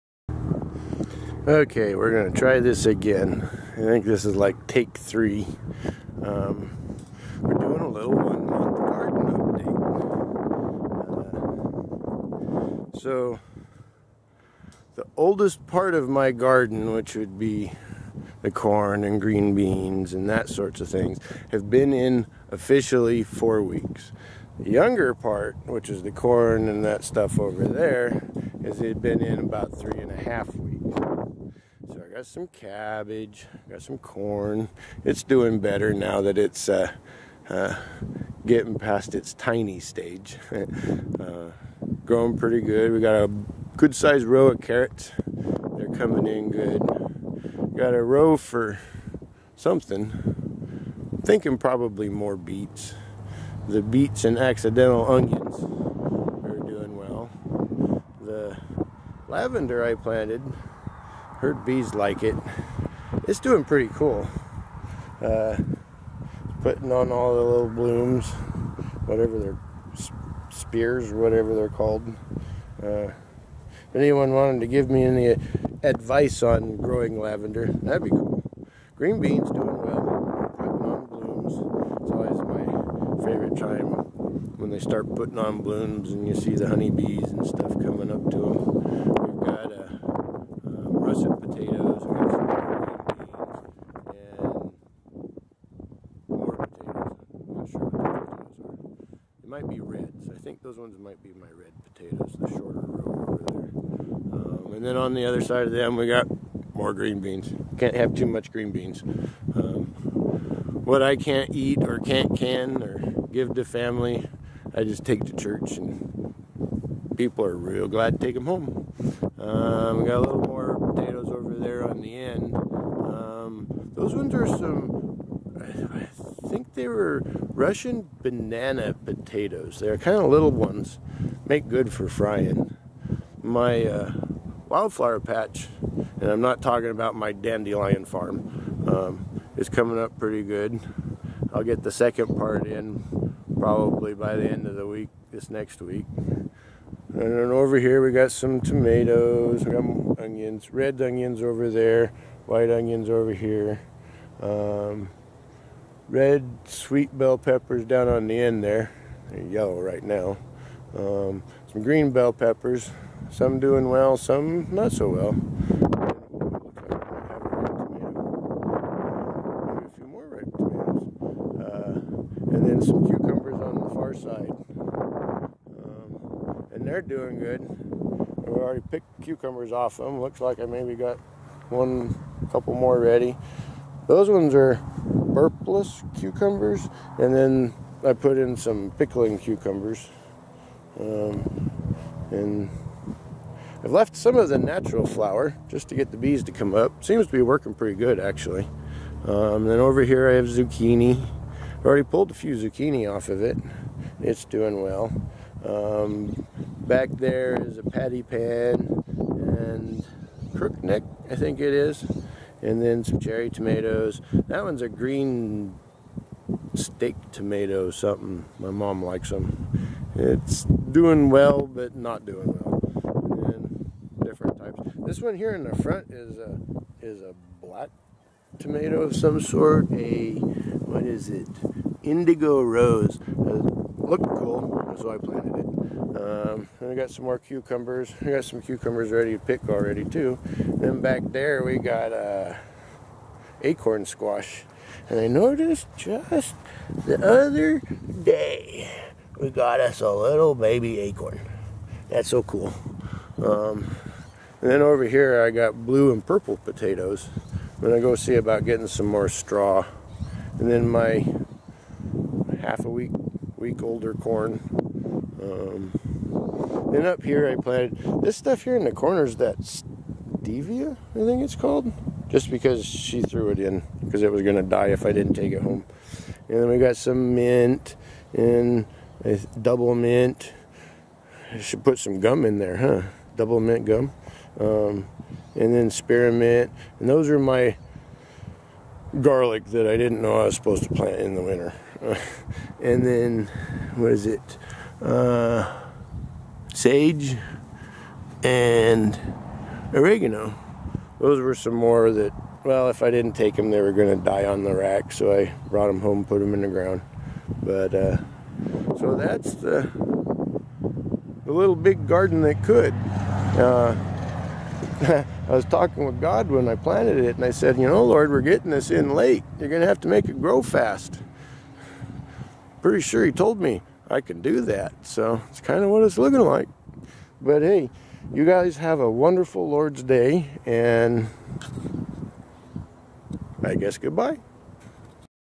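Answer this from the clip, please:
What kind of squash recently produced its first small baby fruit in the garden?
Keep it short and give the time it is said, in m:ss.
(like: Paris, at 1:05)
Acorn squash, at 4:03.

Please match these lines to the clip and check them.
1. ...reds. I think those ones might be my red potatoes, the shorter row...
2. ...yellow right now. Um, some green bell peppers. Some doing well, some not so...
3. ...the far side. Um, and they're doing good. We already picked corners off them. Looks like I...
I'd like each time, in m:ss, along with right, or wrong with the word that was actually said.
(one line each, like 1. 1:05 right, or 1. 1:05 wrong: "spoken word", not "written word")
1. 1:39 right
2. 2:39 right
3. 2:53 wrong: "cucumbers", not "corners".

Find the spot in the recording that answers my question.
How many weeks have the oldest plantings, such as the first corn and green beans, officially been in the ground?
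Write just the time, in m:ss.
0:23.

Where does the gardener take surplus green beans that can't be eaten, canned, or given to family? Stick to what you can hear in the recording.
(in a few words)
Church.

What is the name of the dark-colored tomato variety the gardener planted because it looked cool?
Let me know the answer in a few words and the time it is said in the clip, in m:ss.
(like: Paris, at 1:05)
Indigo Rose, at 3:52.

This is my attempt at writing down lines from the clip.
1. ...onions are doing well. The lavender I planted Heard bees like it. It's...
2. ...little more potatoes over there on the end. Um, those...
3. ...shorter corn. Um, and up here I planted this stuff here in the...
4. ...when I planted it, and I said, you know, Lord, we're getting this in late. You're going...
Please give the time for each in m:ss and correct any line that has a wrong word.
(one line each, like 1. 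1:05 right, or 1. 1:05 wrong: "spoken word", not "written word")
1. 0:55 right
2. 2:00 right
3. 4:23 wrong: "older", not "shorter"
4. 5:16 right.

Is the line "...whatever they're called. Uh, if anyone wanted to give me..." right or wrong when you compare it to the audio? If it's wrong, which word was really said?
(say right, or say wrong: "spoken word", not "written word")
right.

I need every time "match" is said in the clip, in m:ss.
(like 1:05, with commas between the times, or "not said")
not said.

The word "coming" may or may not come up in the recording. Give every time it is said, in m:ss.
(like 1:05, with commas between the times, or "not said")
0:45, 1:27, 2:19.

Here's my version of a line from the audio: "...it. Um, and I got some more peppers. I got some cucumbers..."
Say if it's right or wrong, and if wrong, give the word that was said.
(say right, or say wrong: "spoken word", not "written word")
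wrong: "cucumbers", not "peppers".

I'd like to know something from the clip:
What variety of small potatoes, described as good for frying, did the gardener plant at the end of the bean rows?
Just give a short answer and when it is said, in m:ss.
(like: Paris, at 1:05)
Russian banana, at 2:07.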